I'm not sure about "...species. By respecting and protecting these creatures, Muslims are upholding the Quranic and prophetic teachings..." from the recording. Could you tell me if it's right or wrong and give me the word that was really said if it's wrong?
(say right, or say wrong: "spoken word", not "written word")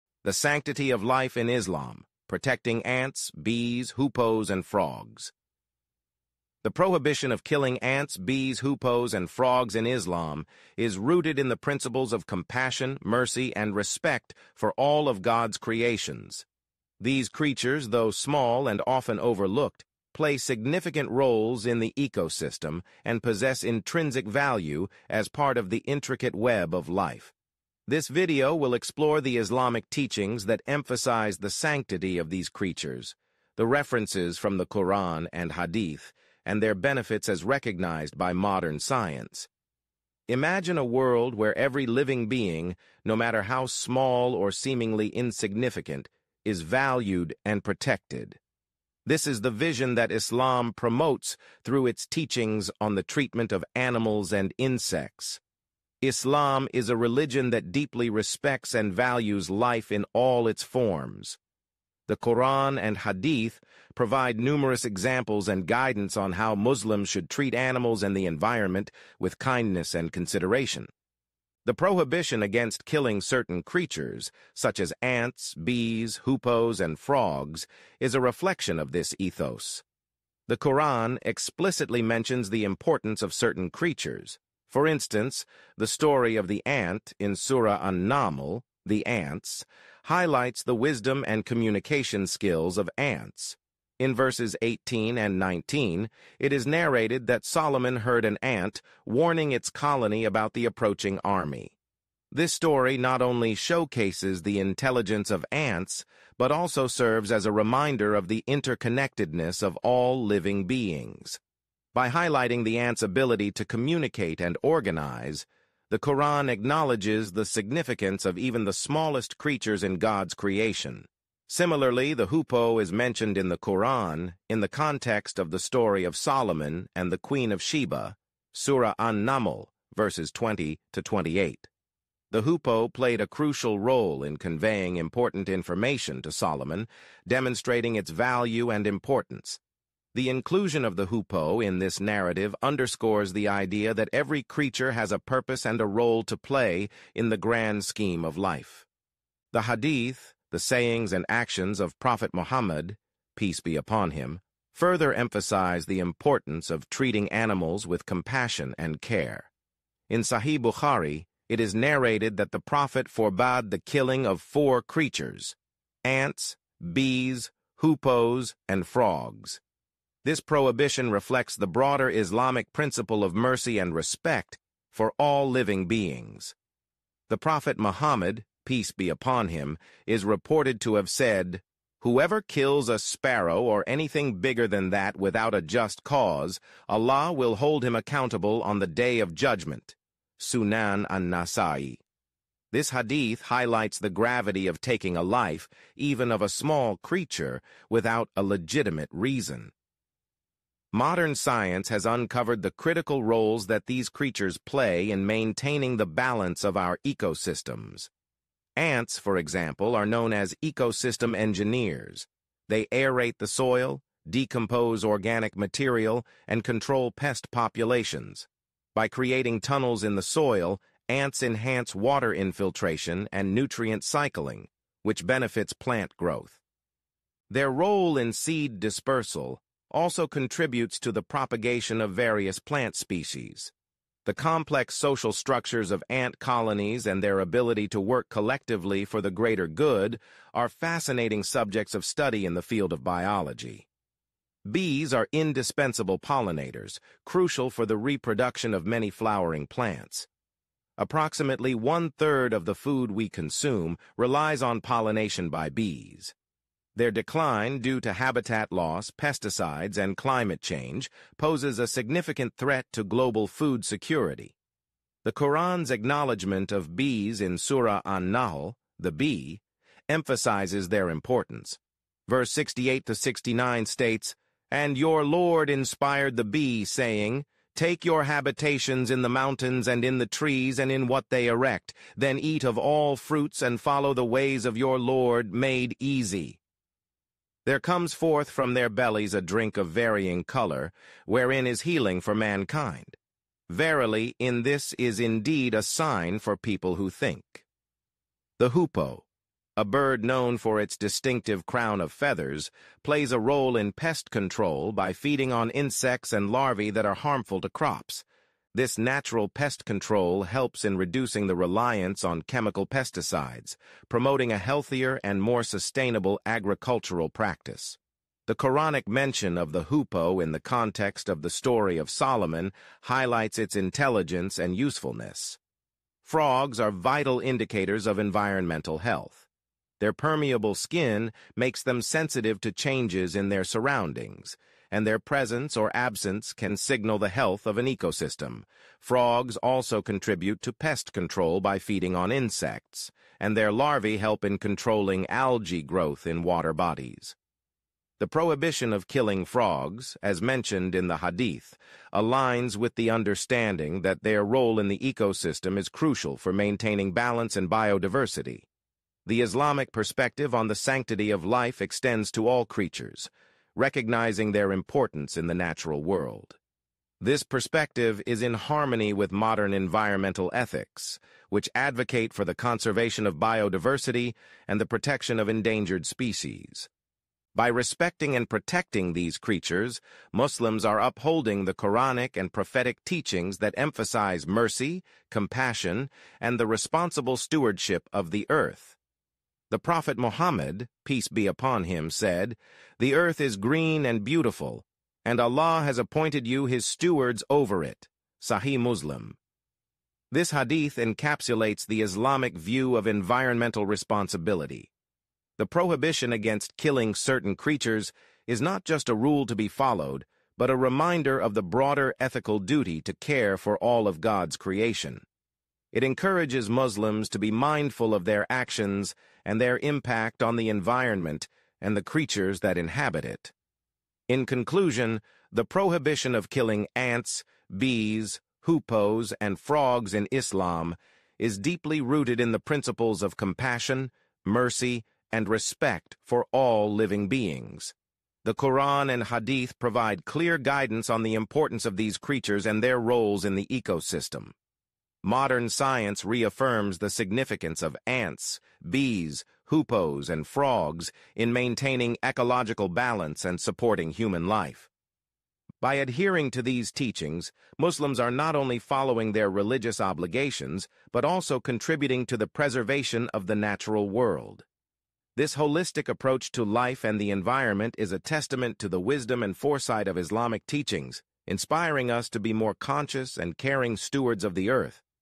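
right.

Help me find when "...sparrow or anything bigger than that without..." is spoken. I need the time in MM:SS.
03:02.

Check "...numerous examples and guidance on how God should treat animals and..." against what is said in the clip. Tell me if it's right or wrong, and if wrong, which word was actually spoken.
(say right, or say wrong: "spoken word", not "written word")
wrong: "Muslims", not "God".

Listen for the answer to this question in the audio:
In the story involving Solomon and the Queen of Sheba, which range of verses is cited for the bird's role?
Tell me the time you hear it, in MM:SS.
02:10.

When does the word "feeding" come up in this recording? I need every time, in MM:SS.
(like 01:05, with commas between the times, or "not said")
05:05, 05:41.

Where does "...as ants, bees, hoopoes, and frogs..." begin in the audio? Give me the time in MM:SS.
01:14.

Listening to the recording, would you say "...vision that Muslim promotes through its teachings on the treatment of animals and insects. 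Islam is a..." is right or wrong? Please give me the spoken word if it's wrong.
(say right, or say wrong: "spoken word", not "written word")
wrong: "Islam", not "Muslim".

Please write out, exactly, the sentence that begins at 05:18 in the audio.
The Quranic mention of the hoopoe in the context of the story of Solomon highlights its intelligence and usefulness.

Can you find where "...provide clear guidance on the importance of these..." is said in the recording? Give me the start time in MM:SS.
07:19.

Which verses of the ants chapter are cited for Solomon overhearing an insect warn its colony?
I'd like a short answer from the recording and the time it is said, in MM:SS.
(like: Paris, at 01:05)
18 and 19, at 01:34.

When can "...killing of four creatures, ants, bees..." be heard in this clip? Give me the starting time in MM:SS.
02:43.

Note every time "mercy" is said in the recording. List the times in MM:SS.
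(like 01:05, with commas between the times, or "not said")
00:13, 02:53, 06:24, 07:14.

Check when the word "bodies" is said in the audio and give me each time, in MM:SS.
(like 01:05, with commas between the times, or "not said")
05:46.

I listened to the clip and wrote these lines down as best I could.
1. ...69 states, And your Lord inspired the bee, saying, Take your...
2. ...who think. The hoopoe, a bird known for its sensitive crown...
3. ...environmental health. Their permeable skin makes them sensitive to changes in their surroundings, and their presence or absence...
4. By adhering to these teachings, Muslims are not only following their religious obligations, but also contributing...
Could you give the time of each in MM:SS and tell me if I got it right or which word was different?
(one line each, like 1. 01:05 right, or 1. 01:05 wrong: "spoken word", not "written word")
1. 04:33 right
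2. 04:56 wrong: "distinctive", not "sensitive"
3. 05:28 right
4. 07:35 right.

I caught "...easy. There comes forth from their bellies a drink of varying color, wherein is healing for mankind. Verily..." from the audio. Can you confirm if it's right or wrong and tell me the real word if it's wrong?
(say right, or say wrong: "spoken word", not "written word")
right.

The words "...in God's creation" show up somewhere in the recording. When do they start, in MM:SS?
01:59.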